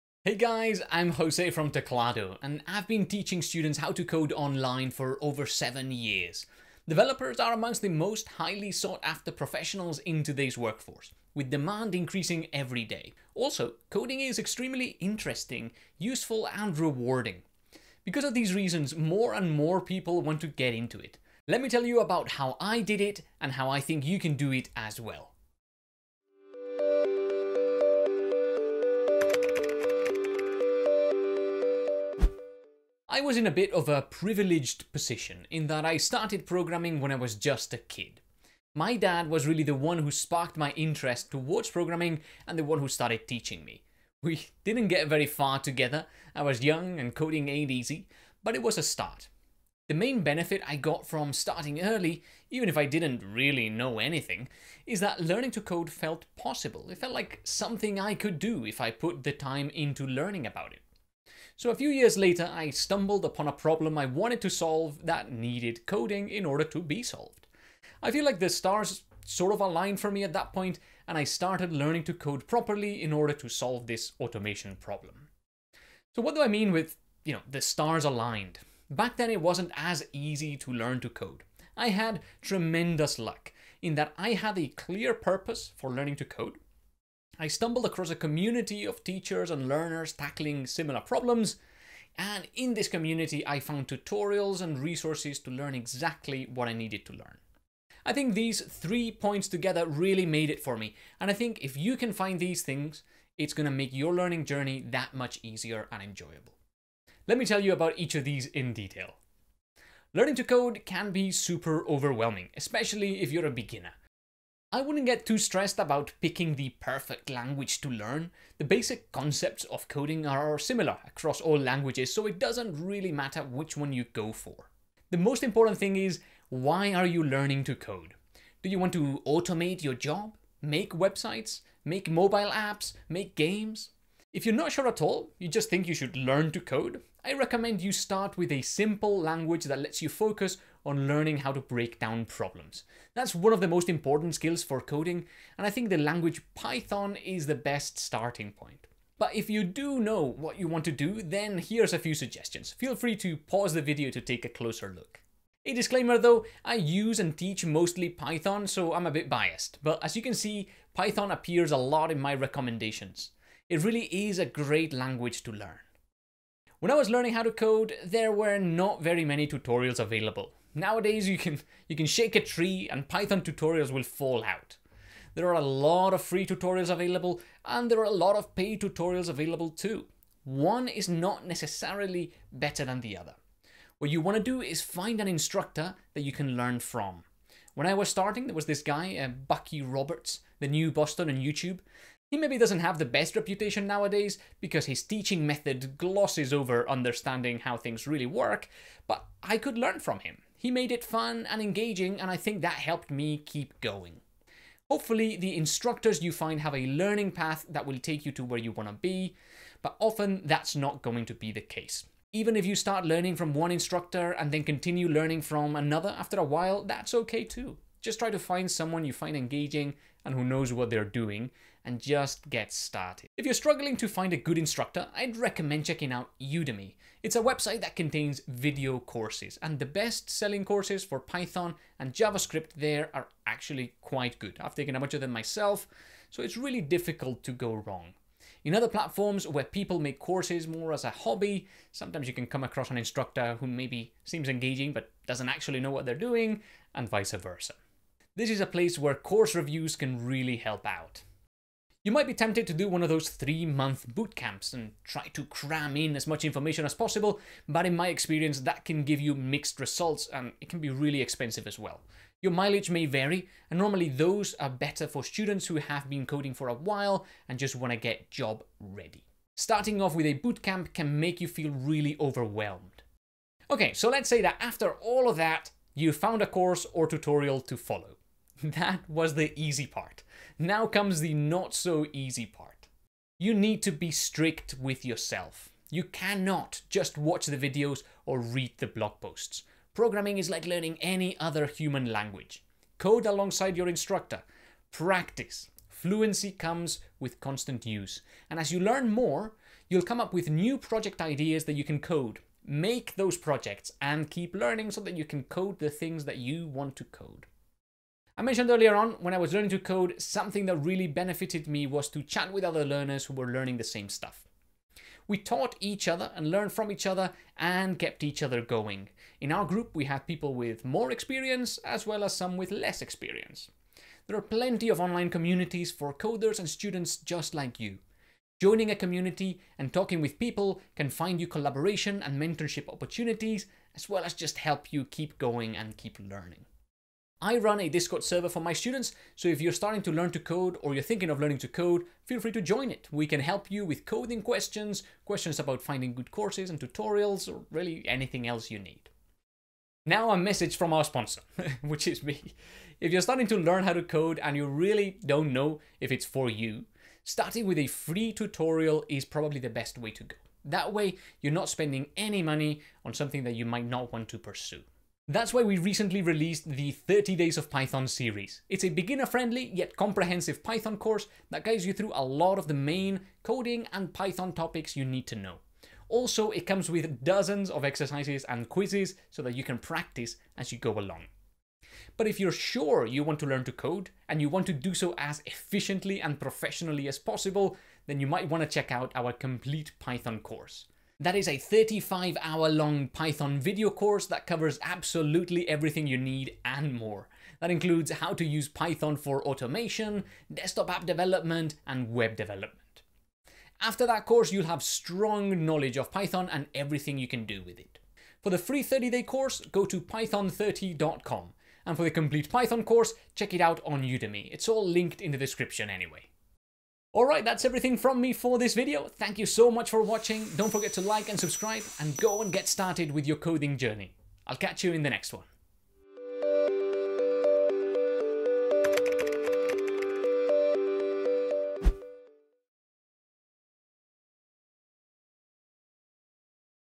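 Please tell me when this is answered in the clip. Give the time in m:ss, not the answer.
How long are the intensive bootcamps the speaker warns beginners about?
4:13.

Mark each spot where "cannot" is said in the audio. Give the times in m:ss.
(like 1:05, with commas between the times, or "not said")
4:46.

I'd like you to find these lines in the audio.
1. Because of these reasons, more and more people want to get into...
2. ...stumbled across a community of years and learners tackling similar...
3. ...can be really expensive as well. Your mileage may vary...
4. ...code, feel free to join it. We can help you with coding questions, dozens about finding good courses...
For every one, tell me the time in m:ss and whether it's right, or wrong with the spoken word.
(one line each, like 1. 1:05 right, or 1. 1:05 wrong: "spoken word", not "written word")
1. 0:18 right
2. 1:27 wrong: "teachers", not "years"
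3. 4:20 right
4. 5:41 wrong: "questions", not "dozens".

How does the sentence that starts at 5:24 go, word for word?
There are plenty of online communities for coders and students just like you.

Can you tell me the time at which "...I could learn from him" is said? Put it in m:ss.
3:19.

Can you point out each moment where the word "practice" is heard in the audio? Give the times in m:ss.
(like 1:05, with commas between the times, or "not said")
4:54, 6:19.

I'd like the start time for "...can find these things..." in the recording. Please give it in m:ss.
1:41.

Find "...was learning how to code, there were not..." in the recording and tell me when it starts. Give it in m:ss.
2:46.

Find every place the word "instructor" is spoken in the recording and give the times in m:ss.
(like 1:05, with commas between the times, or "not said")
3:05, 3:25, 3:33, 3:44, 4:02, 4:53.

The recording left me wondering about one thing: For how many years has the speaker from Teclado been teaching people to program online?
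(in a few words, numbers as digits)
7.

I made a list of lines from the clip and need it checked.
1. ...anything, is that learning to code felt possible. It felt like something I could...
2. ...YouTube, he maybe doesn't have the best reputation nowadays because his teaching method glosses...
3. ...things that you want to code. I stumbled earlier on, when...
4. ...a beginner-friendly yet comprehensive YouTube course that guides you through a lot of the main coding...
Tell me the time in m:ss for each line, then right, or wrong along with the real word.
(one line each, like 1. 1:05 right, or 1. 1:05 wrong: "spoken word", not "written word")
1. 0:53 right
2. 3:11 right
3. 5:05 wrong: "mentioned", not "stumbled"
4. 6:08 wrong: "Python", not "YouTube".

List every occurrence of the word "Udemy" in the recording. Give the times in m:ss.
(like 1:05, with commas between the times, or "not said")
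3:46, 6:54.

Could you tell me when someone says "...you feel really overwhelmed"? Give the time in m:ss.
4:31.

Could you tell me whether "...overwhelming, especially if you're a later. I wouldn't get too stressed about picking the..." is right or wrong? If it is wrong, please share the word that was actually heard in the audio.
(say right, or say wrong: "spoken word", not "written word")
wrong: "beginner", not "later".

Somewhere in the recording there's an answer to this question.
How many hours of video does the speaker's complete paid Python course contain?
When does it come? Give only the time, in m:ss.
6:31.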